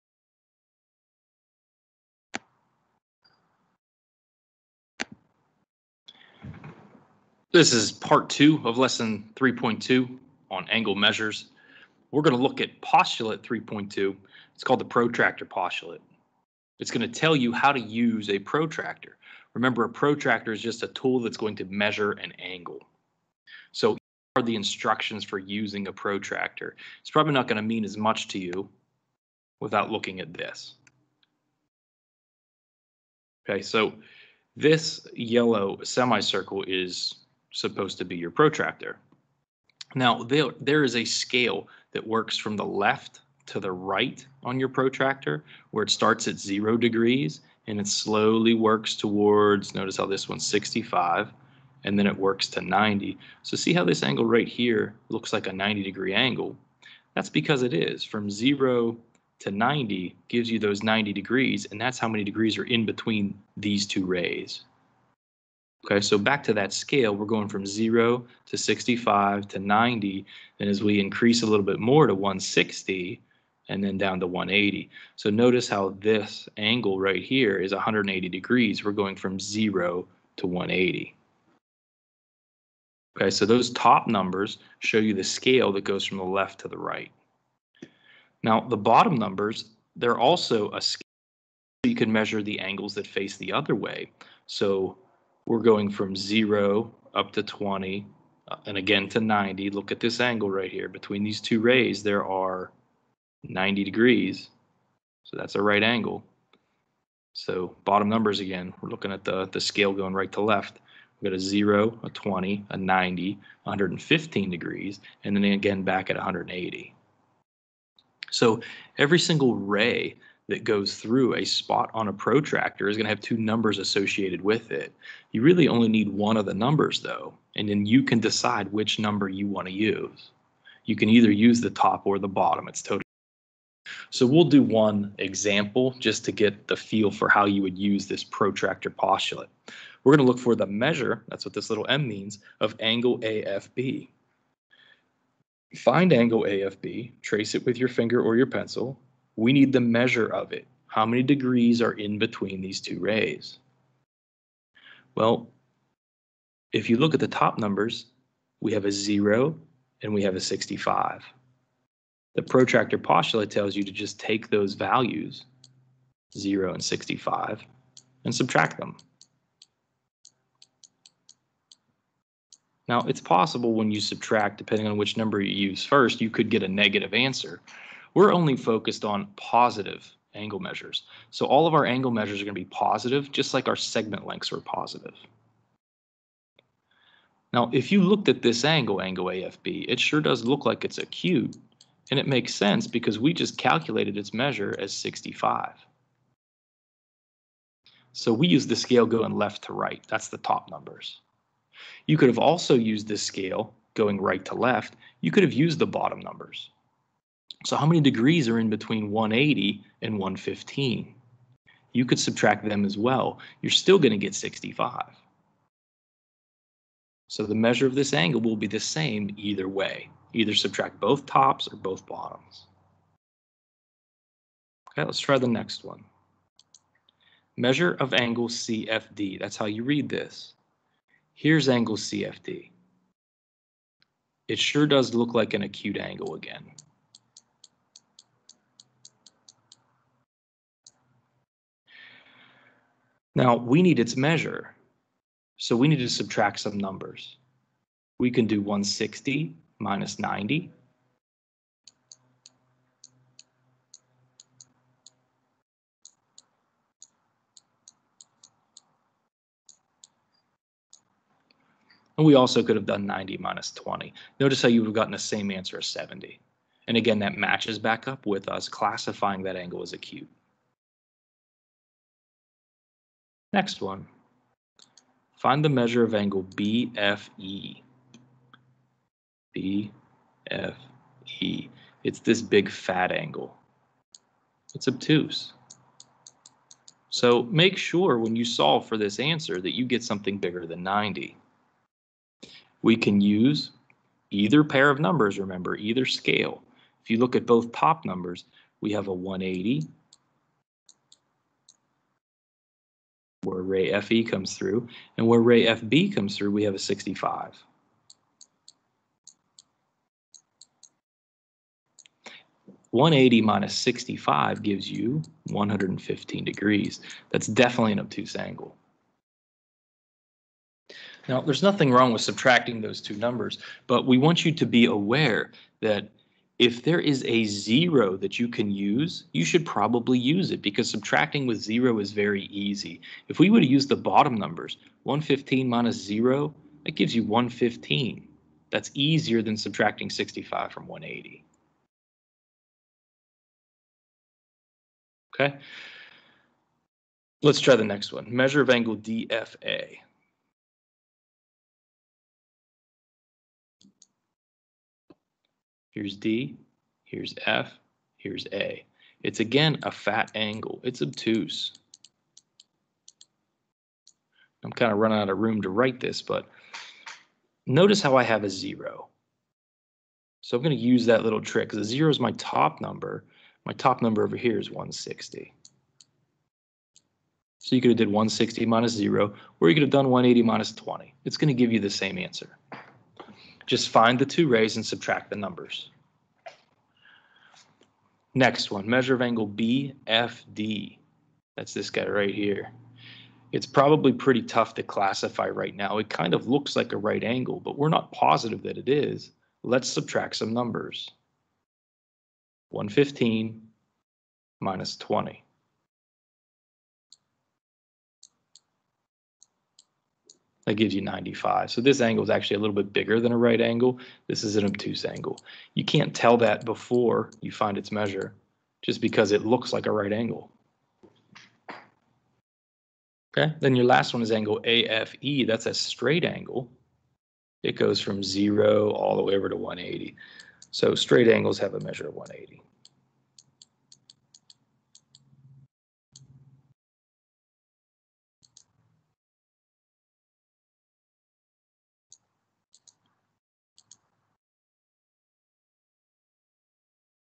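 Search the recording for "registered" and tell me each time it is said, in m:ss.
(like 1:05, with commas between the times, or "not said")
not said.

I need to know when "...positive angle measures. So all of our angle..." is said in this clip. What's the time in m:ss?
2:59.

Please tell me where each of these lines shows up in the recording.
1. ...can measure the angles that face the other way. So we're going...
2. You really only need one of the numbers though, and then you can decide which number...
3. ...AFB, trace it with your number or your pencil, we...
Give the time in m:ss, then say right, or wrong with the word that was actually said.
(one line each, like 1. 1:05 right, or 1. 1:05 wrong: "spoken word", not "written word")
1. 1:31 right
2. 2:05 right
3. 2:26 wrong: "finger", not "number".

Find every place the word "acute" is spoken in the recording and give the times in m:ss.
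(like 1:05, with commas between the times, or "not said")
3:10, 3:55, 4:29.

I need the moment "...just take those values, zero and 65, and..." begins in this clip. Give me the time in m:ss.
2:43.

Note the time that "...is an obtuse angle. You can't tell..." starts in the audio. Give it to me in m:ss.
6:54.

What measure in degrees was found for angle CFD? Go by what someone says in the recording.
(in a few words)
70.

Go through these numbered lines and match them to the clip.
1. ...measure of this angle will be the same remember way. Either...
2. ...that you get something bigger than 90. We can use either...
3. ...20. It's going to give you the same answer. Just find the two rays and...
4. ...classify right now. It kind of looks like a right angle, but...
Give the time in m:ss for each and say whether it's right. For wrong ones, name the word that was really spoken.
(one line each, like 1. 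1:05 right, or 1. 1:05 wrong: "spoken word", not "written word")
1. 3:37 wrong: "either", not "remember"
2. 4:49 right
3. 6:20 right
4. 6:34 right.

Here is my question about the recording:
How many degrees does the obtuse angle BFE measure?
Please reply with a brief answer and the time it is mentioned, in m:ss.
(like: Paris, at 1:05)
115, at 5:15.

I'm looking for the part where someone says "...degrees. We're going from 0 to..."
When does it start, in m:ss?
1:18.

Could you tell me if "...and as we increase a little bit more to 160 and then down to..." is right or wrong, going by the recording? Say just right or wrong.
right.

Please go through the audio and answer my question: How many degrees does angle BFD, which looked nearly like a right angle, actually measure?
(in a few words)
95.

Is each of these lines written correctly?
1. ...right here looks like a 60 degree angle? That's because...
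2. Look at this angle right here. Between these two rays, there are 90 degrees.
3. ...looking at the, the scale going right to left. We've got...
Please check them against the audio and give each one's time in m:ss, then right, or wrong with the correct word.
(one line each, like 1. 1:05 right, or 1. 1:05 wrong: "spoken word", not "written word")
1. 0:54 wrong: "90", not "60"
2. 1:39 right
3. 1:48 right.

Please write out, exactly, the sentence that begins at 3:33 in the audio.
You're still going to get 65.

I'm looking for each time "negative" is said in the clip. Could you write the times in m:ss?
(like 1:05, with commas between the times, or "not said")
2:56.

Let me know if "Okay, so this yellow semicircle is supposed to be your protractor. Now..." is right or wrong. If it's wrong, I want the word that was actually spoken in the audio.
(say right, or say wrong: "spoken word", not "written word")
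right.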